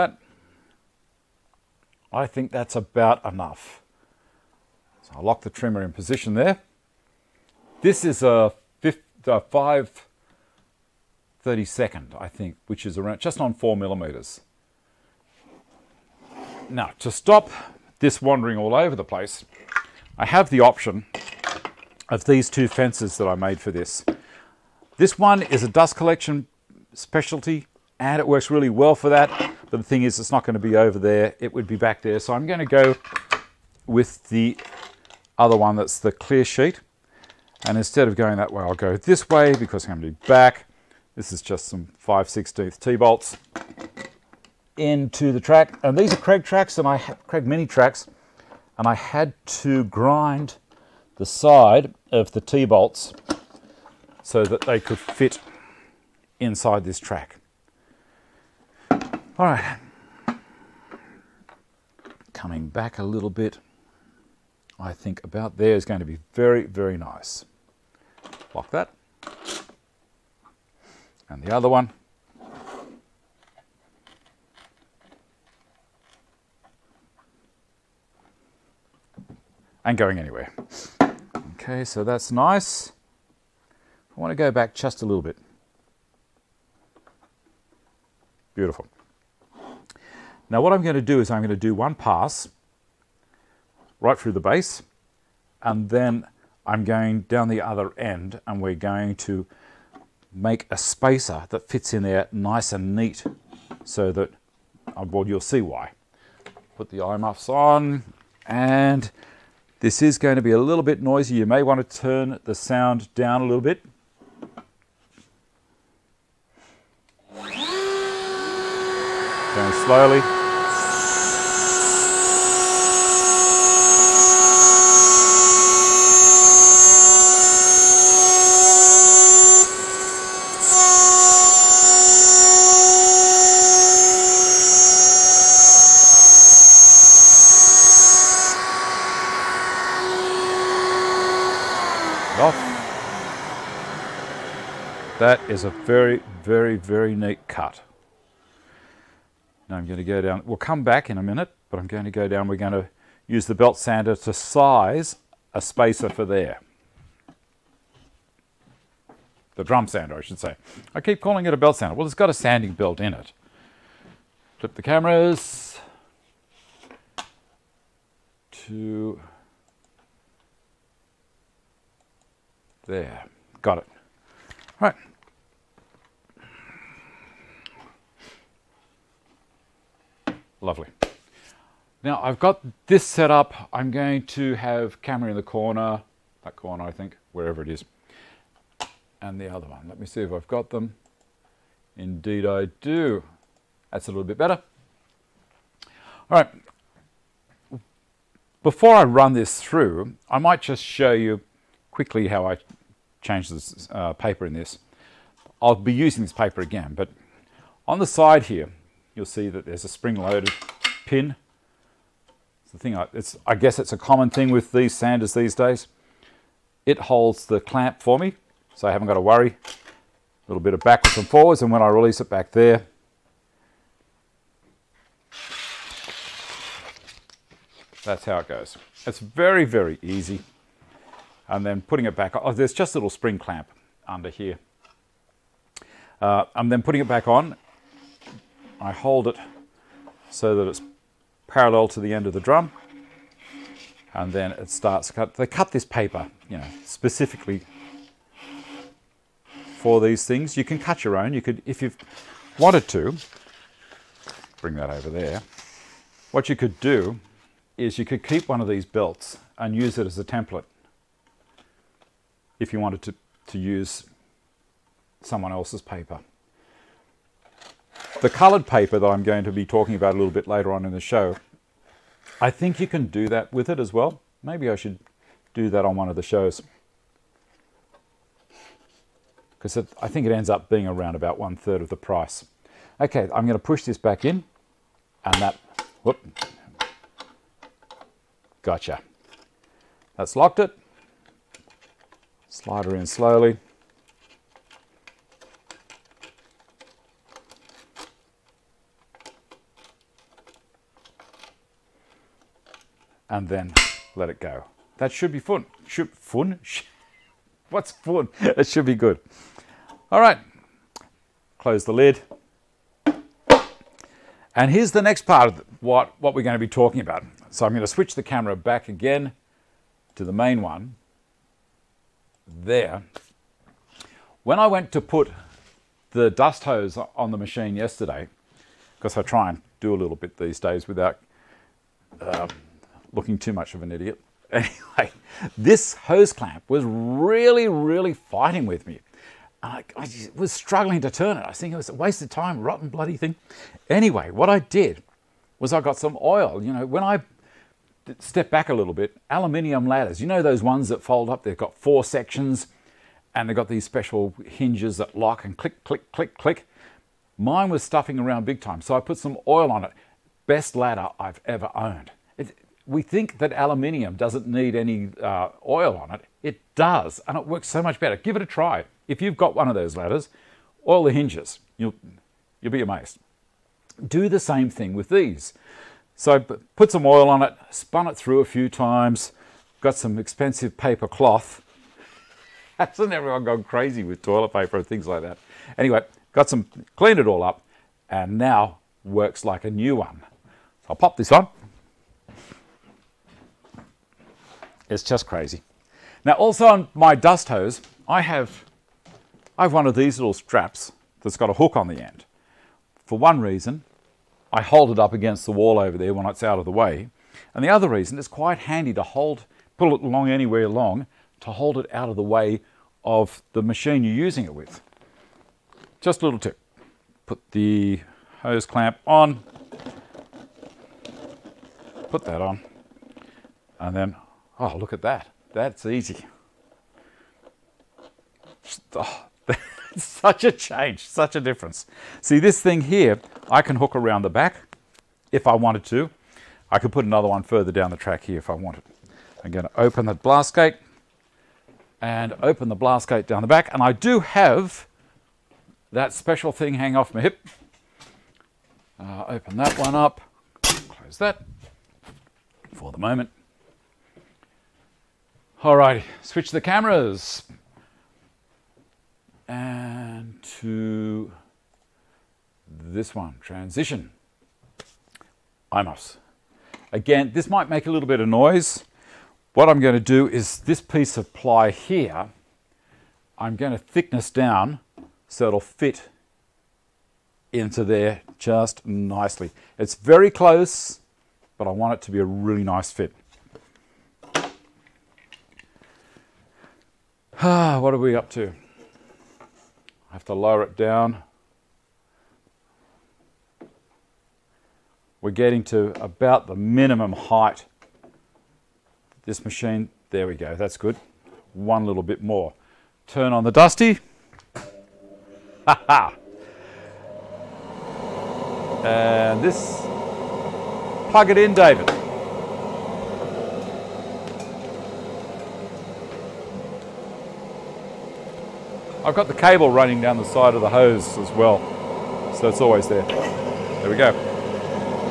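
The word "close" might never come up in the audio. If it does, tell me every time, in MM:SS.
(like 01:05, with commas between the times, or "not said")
05:11, 07:30, 08:00.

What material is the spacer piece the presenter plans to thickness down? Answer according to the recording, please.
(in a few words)
ply.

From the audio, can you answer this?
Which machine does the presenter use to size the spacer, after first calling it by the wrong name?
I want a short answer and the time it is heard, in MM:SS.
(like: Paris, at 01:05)
drum sander, at 02:39.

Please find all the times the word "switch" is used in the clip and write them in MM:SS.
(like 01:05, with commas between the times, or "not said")
05:17, 07:36.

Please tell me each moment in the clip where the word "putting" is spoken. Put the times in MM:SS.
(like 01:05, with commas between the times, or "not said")
03:51, 03:56.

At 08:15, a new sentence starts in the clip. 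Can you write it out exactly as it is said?
We're getting to about the minimum height.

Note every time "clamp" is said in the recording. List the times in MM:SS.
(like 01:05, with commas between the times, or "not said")
03:37, 03:53, 05:36, 06:58.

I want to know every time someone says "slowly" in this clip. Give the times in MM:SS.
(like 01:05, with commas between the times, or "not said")
01:59, 04:53.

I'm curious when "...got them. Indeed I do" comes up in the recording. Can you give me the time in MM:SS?
03:10.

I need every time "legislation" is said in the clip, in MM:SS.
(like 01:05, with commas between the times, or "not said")
not said.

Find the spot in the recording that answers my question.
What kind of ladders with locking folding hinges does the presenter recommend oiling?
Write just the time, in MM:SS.
05:49.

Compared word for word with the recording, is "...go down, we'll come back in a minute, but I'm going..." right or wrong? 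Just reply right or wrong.
right.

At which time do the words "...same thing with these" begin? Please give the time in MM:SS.
06:14.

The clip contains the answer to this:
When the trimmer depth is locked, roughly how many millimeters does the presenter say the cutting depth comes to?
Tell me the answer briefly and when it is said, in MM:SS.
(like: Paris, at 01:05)
4 millimeters, at 00:13.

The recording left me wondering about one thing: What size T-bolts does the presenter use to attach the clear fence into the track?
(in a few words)
5/16.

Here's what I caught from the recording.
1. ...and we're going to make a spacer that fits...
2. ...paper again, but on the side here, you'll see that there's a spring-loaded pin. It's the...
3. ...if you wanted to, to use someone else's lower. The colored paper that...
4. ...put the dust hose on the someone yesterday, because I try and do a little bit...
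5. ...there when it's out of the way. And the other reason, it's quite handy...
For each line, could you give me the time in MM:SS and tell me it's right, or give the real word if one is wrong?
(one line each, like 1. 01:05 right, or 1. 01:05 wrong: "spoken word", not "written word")
1. 01:38 right
2. 03:26 right
3. 04:22 wrong: "paper", not "lower"
4. 05:24 wrong: "machine", not "someone"
5. 06:45 right.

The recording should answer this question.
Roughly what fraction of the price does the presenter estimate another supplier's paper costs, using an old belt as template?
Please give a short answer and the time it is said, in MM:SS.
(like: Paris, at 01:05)
one third, at 04:41.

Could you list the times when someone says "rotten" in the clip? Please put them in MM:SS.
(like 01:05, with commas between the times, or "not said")
05:42.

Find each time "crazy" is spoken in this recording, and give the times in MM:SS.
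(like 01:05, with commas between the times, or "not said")
06:23, 06:35.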